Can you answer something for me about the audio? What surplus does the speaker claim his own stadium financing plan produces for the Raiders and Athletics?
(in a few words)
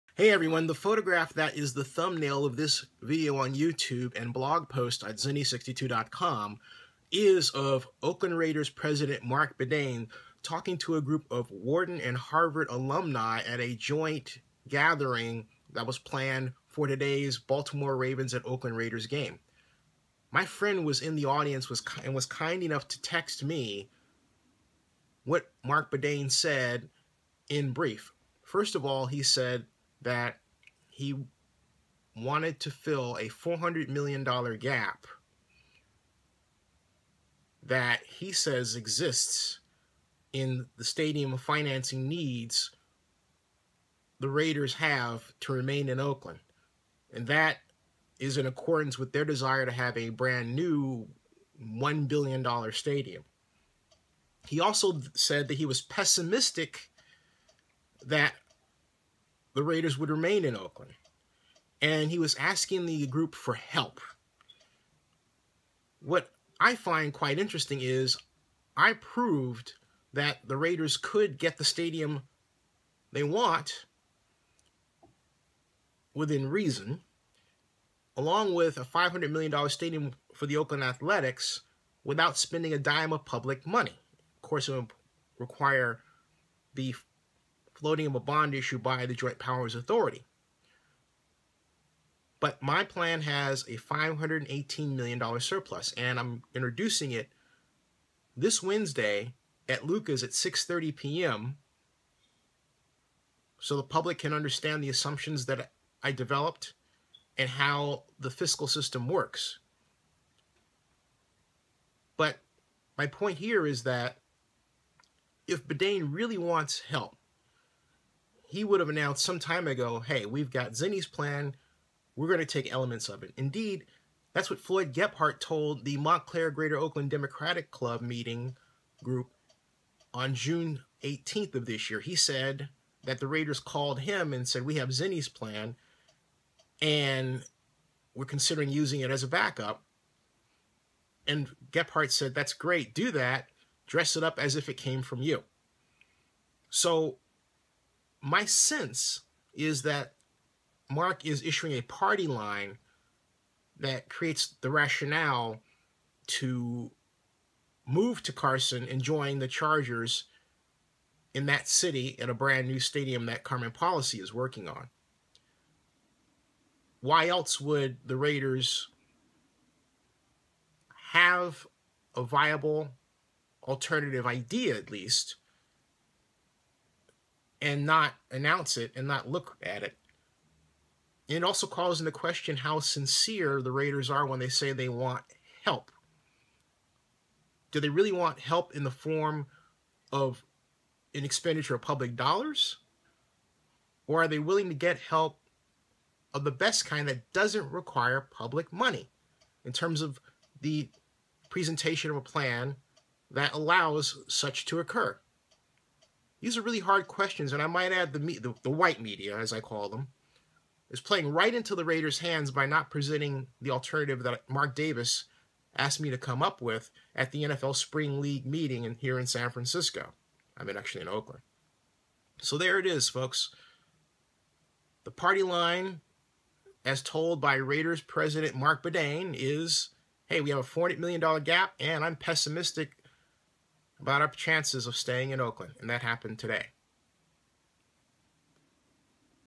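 $518 million.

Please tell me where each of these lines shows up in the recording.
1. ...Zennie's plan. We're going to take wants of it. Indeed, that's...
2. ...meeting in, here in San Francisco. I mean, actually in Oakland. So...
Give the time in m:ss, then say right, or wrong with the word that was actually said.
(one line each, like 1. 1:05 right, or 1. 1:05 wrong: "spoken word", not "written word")
1. 2:00 wrong: "elements", not "wants"
2. 3:38 right.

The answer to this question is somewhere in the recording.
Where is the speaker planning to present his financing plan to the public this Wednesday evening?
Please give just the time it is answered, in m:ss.
1:39.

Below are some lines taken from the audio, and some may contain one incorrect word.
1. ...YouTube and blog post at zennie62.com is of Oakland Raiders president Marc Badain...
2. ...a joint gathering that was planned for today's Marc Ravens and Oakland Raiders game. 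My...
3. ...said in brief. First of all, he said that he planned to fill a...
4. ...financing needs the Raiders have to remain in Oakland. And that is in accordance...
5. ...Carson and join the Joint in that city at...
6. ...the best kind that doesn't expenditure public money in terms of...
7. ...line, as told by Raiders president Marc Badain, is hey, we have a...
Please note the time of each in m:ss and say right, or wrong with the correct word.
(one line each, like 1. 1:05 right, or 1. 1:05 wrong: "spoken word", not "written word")
1. 0:03 right
2. 0:13 wrong: "Baltimore", not "Marc"
3. 0:26 wrong: "wanted", not "planned"
4. 0:41 right
5. 2:38 wrong: "Chargers", not "Joint"
6. 3:16 wrong: "require", not "expenditure"
7. 3:45 right.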